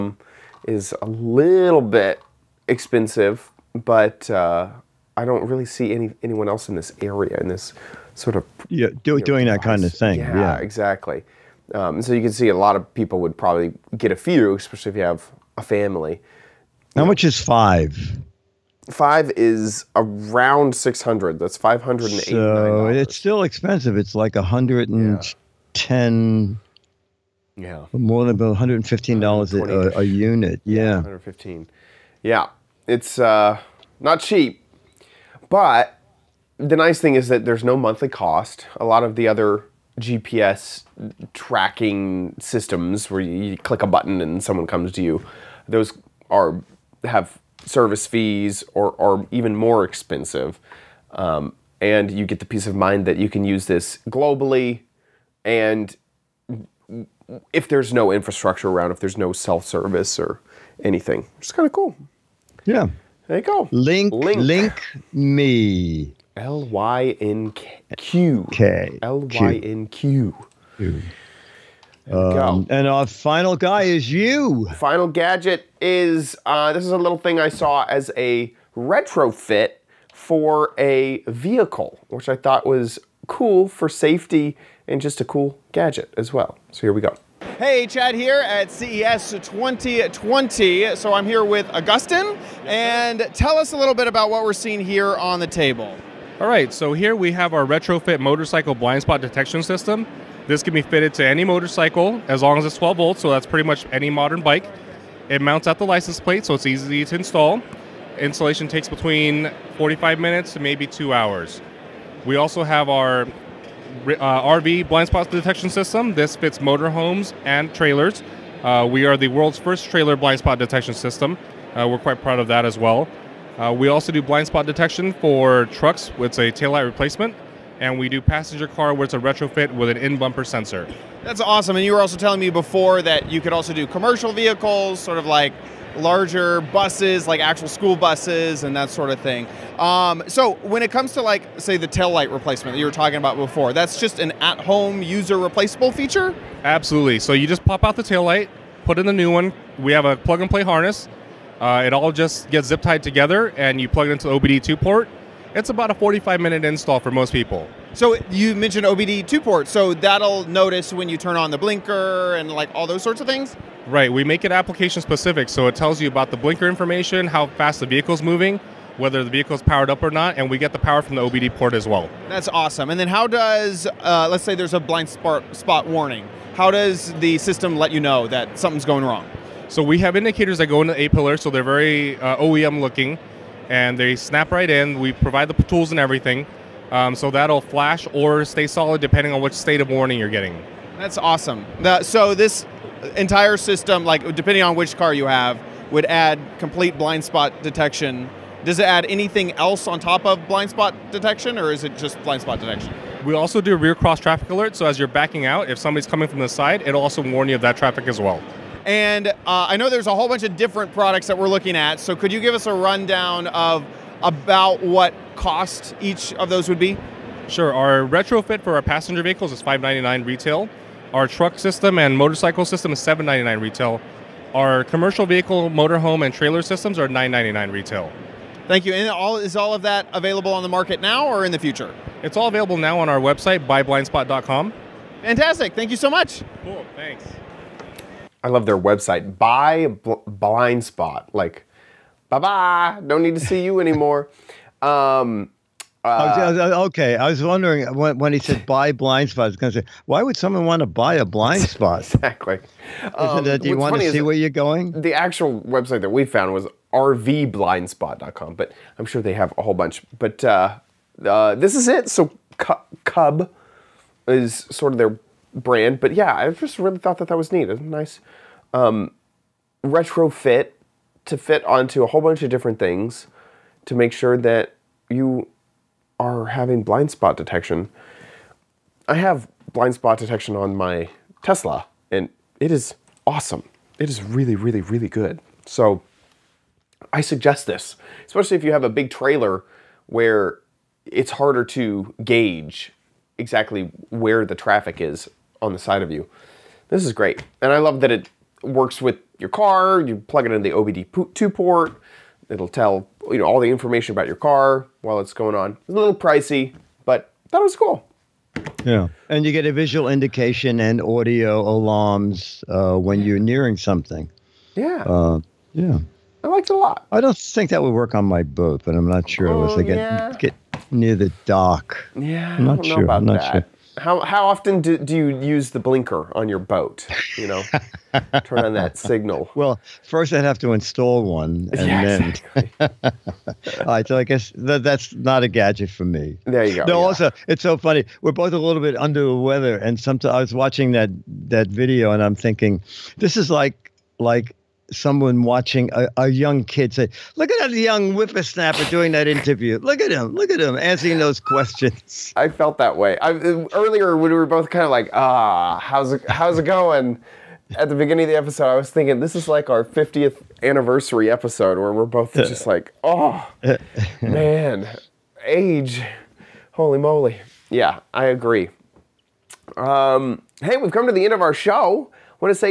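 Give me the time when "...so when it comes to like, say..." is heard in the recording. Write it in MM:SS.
02:20.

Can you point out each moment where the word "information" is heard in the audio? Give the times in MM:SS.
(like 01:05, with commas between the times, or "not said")
02:46, 05:03.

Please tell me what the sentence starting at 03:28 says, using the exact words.
And uh, I know there's a whole bunch of different products that we're looking at.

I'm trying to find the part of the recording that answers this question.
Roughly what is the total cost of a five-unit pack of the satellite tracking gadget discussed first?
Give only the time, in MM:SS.
00:21.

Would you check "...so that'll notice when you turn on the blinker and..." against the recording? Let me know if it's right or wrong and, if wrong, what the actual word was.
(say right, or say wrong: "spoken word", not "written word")
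right.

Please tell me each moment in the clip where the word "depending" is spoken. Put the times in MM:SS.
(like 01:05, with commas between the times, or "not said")
03:09, 03:14.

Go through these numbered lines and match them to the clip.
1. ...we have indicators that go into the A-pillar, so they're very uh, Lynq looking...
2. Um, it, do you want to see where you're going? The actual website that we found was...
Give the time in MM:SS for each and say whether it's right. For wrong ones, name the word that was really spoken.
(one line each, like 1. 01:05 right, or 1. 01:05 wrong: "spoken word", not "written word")
1. 02:59 wrong: "OEM", not "Lynq"
2. 04:13 right.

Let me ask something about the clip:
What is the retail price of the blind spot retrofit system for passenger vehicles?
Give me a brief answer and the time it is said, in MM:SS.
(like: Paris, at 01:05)
$599, at 03:39.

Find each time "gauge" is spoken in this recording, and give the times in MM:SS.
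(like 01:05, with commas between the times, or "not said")
04:52.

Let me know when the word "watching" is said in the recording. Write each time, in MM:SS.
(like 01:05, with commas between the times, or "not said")
05:40, 05:45.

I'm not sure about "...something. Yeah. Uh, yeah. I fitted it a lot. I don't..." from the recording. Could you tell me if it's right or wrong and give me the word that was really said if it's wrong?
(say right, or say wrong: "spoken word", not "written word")
wrong: "liked", not "fitted".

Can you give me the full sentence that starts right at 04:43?
It is really, really, really good.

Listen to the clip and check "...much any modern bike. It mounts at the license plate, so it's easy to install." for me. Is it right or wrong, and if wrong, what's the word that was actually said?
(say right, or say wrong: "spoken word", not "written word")
right.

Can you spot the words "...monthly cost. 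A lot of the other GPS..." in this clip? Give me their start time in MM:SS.
00:37.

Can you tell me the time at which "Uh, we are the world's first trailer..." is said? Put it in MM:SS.
01:58.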